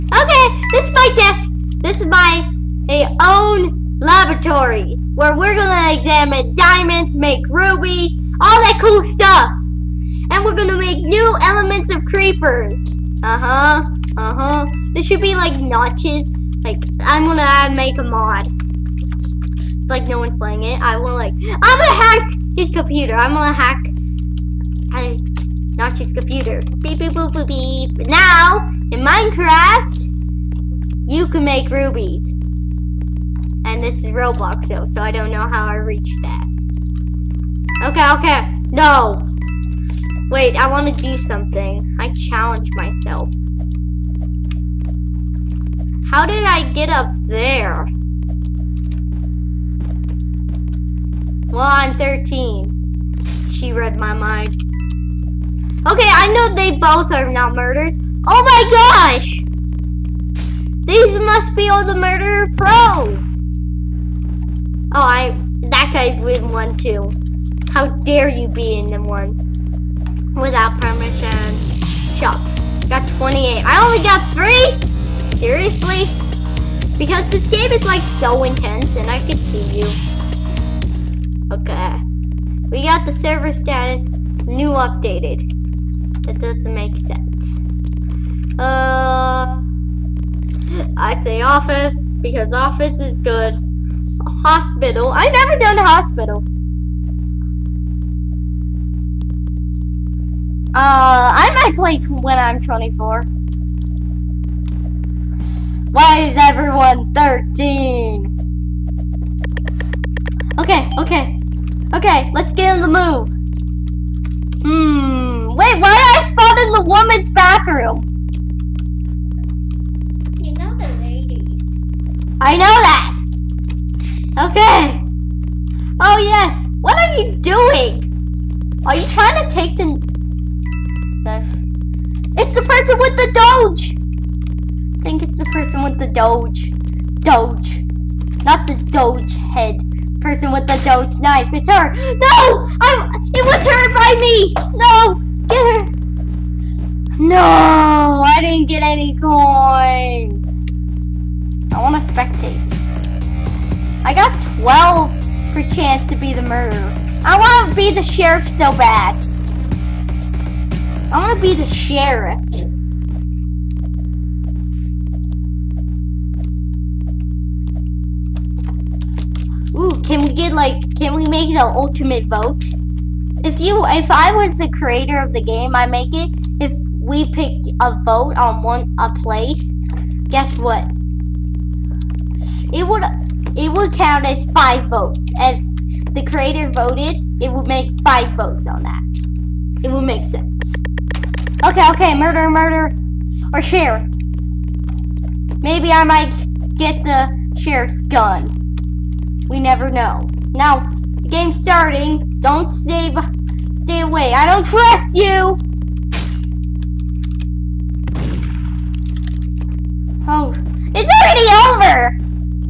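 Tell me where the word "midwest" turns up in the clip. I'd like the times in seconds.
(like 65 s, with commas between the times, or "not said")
not said.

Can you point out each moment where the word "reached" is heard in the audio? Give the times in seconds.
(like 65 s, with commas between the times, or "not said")
35 s.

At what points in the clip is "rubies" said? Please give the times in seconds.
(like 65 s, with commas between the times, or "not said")
7 s, 31 s.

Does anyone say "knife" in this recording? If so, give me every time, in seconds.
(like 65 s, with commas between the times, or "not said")
131 s, 141 s.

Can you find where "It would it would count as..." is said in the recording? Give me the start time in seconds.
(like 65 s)
182 s.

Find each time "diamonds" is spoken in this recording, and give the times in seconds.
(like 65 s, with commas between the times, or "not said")
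6 s.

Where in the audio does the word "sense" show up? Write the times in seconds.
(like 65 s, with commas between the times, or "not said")
86 s, 190 s.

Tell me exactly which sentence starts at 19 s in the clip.
It's like no one's playing it.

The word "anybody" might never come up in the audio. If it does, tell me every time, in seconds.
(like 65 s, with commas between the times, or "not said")
not said.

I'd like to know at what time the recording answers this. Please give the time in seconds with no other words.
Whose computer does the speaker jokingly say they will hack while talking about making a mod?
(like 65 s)
25 s.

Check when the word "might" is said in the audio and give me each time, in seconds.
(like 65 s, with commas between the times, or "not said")
101 s, 196 s.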